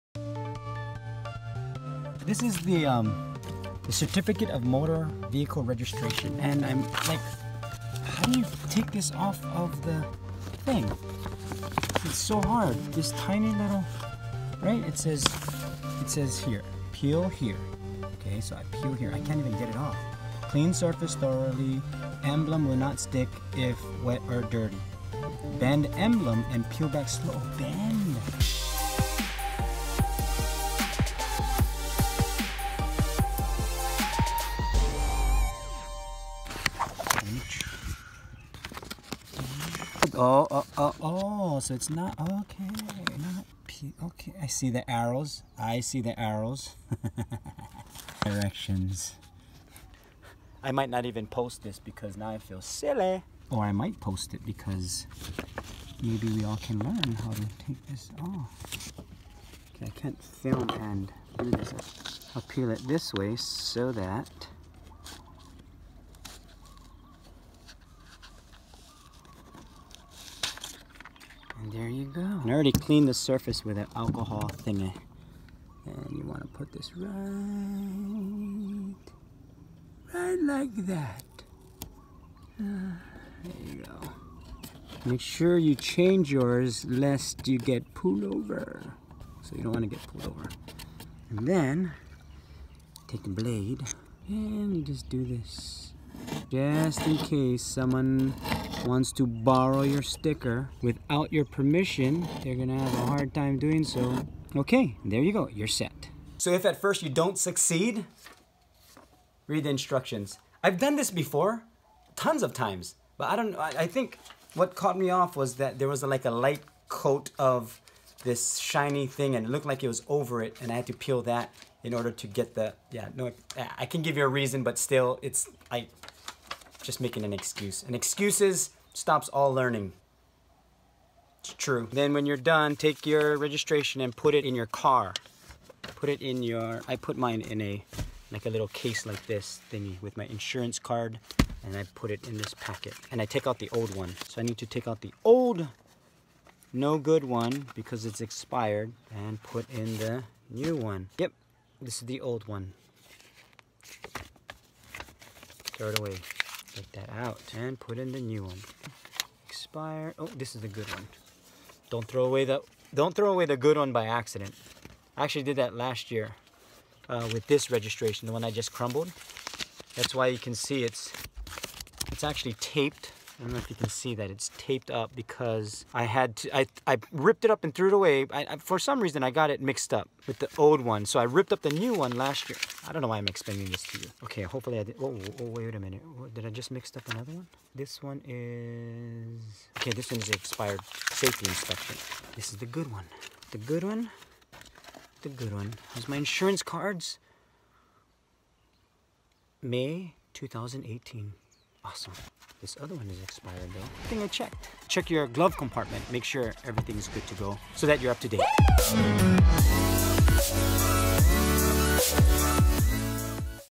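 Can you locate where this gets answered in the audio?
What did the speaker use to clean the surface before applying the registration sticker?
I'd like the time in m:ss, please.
1:13.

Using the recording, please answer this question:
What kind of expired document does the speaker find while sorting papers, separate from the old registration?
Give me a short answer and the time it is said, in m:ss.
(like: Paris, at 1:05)
Safety inspection, at 3:11.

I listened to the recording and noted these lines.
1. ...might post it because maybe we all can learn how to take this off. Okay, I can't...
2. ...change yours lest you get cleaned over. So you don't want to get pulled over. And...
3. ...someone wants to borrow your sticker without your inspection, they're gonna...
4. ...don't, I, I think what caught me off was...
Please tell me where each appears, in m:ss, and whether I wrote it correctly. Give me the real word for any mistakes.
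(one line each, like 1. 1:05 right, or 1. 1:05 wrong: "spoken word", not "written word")
1. 0:53 right
2. 1:25 wrong: "pulled", not "cleaned"
3. 1:37 wrong: "permission", not "inspection"
4. 1:53 right.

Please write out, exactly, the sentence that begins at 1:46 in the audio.
So if at first you don't succeed, read the instructions.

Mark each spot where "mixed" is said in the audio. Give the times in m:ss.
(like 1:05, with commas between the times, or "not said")
2:59, 3:06.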